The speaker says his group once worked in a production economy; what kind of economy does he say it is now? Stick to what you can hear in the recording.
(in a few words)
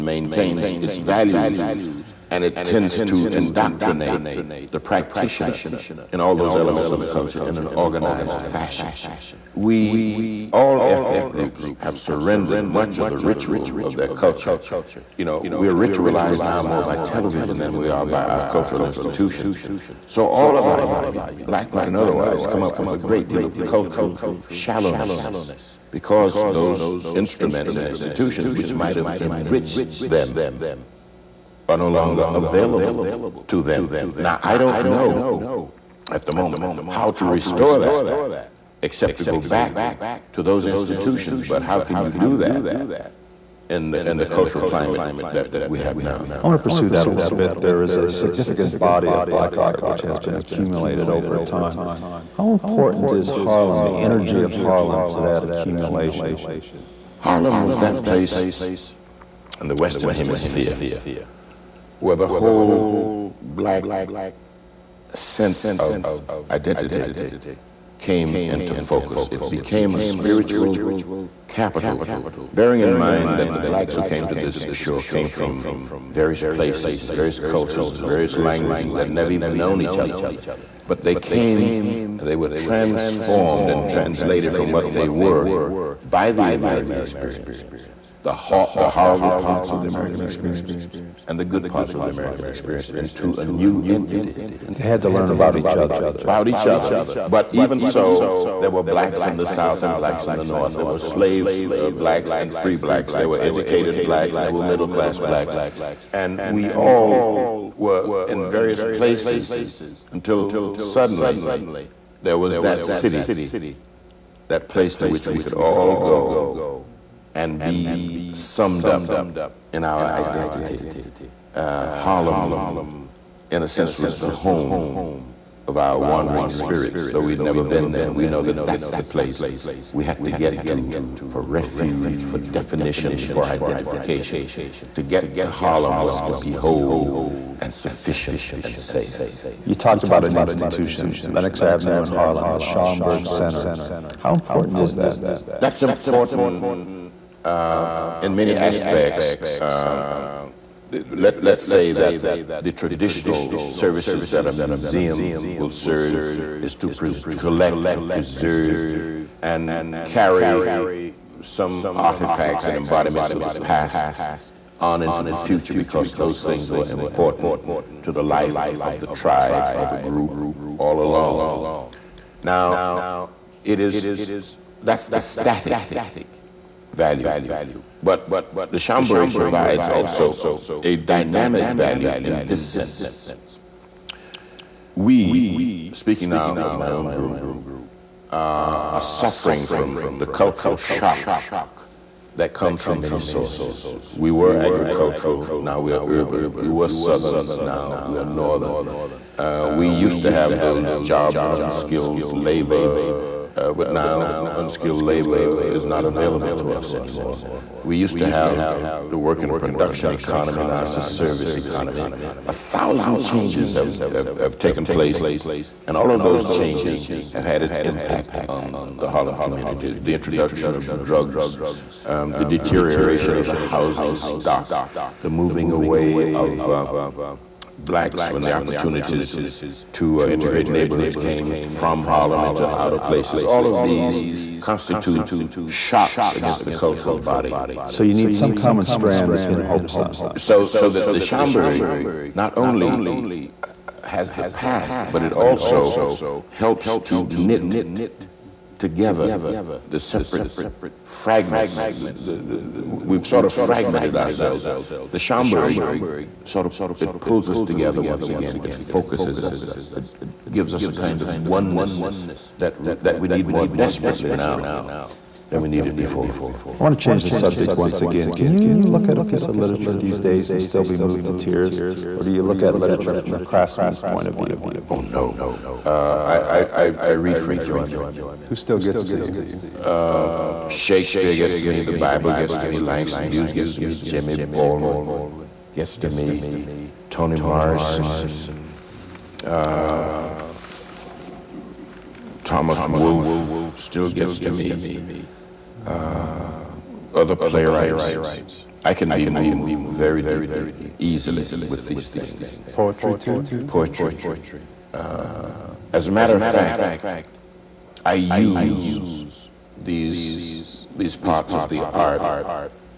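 Service economy.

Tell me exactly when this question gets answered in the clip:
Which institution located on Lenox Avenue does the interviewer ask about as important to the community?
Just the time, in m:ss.
2:22.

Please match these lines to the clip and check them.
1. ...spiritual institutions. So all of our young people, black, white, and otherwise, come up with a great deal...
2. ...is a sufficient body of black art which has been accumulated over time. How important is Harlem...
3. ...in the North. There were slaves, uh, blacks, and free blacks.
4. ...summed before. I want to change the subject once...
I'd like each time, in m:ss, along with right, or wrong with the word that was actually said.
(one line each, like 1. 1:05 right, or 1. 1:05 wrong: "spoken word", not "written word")
1. 0:18 wrong: "cultural", not "spiritual"
2. 0:47 wrong: "significant", not "sufficient"
3. 1:40 right
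4. 4:25 wrong: "needed", not "summed".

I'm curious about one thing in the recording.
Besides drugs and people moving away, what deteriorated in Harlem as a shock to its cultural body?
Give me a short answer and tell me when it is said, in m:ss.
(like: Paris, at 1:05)
The housing stock, at 3:43.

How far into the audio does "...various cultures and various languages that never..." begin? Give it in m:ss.
1:17.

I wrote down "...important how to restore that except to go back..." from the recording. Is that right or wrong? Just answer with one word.
wrong.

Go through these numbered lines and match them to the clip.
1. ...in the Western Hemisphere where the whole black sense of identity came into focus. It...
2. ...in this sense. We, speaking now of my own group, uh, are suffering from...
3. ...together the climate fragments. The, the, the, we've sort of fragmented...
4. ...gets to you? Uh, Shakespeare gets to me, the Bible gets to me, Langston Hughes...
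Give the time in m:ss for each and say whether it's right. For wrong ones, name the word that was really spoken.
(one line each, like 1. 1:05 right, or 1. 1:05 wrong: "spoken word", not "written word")
1. 0:59 right
2. 3:02 right
3. 4:08 wrong: "separate", not "climate"
4. 4:38 right.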